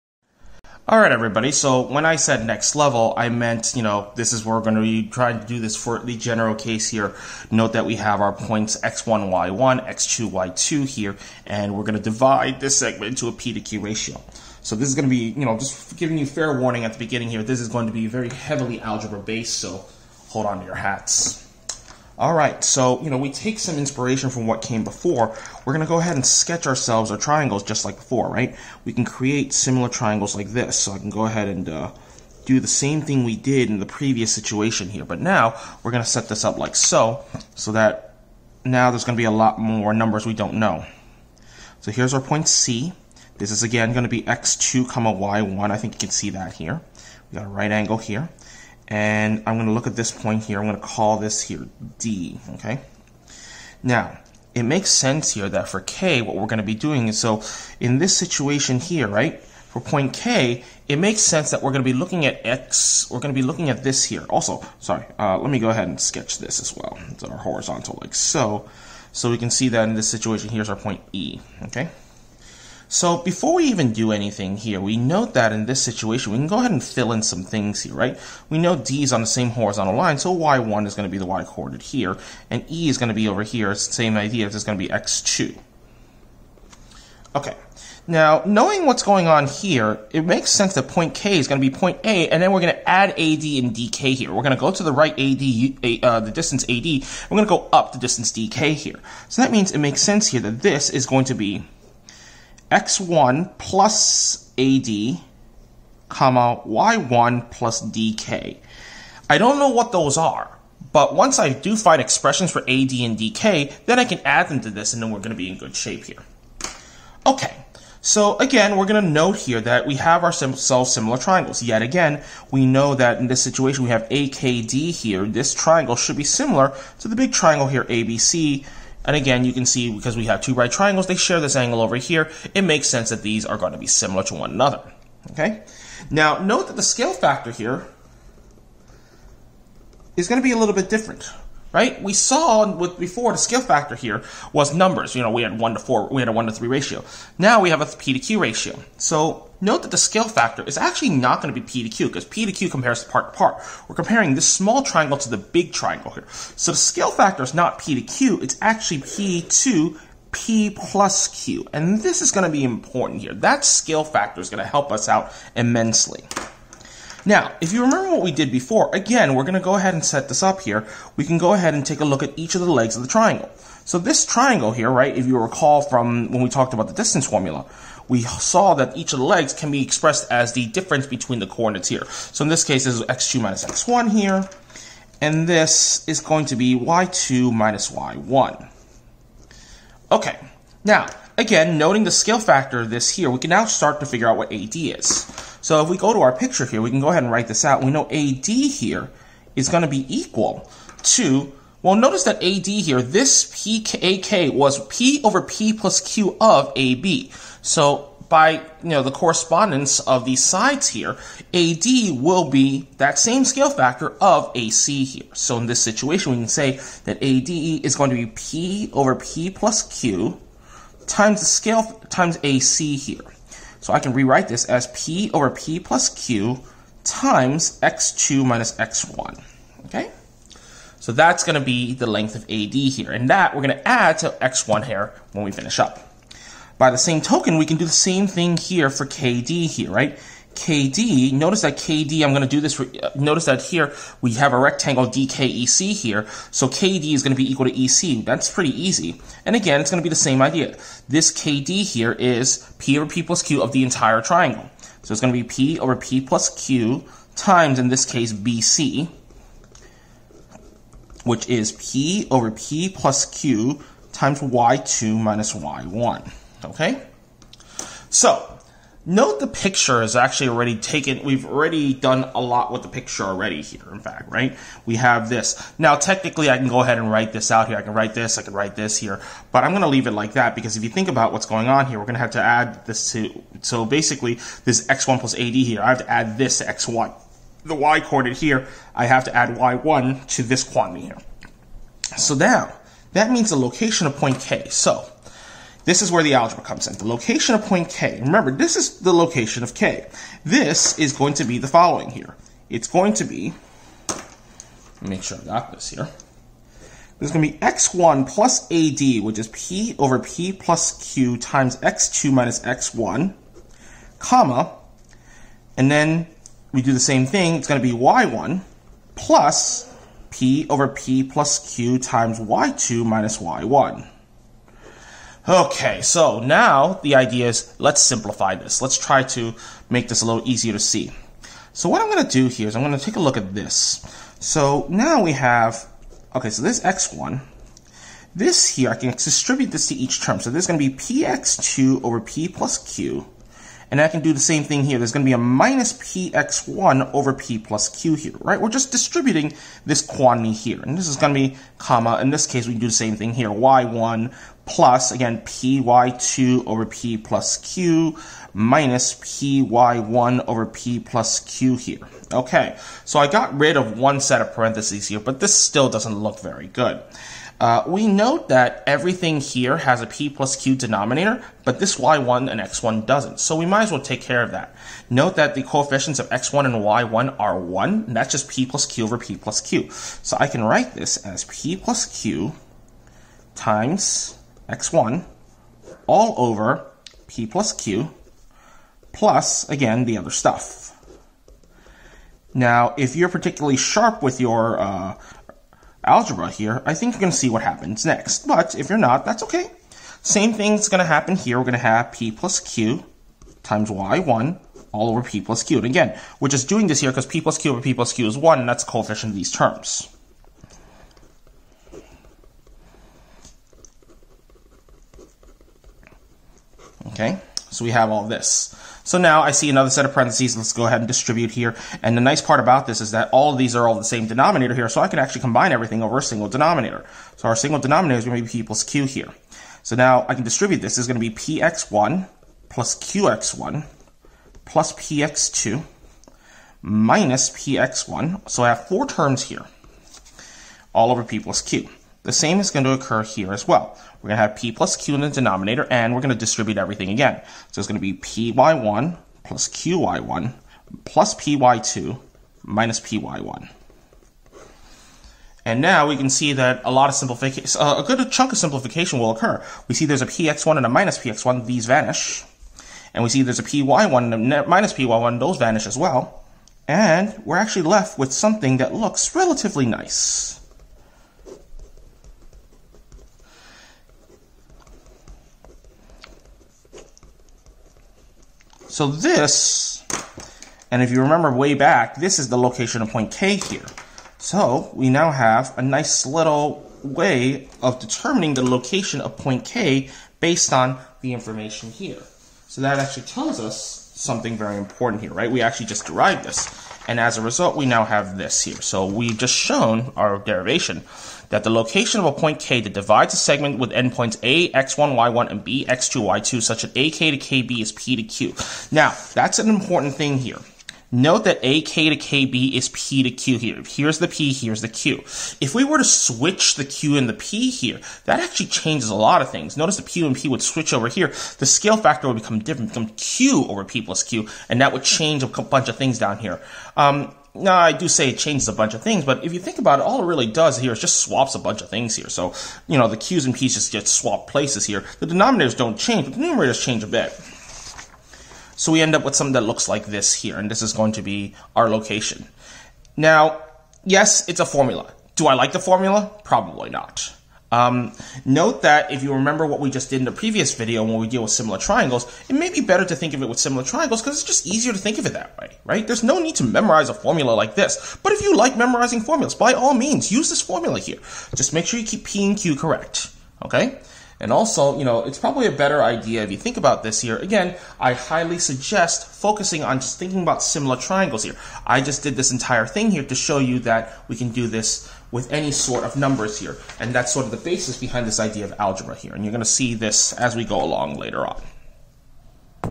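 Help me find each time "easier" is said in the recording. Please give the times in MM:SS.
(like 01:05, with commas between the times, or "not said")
05:30, 09:14.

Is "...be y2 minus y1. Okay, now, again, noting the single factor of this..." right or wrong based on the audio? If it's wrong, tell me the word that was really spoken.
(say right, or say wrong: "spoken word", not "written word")
wrong: "scale", not "single".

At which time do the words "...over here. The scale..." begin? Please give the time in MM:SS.
08:40.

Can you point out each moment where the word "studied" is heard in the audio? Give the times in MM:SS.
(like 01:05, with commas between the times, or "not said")
not said.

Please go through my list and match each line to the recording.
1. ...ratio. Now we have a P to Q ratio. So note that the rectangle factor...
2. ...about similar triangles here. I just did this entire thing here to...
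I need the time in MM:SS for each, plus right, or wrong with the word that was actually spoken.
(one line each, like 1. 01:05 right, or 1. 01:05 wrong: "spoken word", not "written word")
1. 02:26 wrong: "scale", not "rectangle"
2. 09:30 right.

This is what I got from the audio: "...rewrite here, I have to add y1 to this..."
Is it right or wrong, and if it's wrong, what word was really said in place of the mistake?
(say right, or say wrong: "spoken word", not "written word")
wrong: "coordinate", not "rewrite".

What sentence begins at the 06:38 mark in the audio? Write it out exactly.
But if you're not, that's okay.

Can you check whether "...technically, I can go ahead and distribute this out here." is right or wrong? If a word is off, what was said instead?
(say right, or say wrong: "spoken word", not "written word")
wrong: "write", not "distribute".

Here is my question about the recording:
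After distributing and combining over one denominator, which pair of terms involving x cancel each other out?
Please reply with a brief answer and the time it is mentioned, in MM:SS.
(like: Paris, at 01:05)
px1 and minus px1, at 07:40.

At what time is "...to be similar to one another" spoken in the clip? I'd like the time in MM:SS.
02:13.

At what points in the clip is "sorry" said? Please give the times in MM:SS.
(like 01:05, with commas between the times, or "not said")
01:04.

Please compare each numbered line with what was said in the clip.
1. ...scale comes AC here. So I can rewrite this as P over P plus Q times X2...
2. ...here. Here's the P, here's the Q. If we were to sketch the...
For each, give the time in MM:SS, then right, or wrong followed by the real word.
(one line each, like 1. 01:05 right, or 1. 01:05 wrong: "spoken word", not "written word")
1. 03:41 wrong: "times", not "comes"
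2. 08:33 wrong: "switch", not "sketch".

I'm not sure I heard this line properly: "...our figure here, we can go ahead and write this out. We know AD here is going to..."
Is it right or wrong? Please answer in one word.
wrong.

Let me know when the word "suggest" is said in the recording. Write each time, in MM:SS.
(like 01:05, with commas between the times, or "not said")
09:28.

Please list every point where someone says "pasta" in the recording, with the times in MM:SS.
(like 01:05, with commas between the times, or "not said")
not said.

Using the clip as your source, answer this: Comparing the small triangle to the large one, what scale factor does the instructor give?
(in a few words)
P to P plus Q.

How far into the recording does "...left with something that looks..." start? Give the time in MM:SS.
07:47.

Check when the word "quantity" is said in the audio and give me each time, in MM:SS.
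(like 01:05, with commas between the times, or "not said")
04:50, 05:50.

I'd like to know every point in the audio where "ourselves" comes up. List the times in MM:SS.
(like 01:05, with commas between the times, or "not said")
00:26, 02:00.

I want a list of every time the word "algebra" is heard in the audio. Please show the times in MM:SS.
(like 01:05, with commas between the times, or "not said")
00:18, 04:56, 06:36, 09:38.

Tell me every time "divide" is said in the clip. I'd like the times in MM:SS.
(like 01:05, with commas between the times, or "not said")
00:12, 08:22.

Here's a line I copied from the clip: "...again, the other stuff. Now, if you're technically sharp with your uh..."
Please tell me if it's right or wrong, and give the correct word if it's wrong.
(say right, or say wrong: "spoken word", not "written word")
wrong: "particularly", not "technically".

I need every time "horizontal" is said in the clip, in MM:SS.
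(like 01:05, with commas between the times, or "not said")
01:07, 01:19.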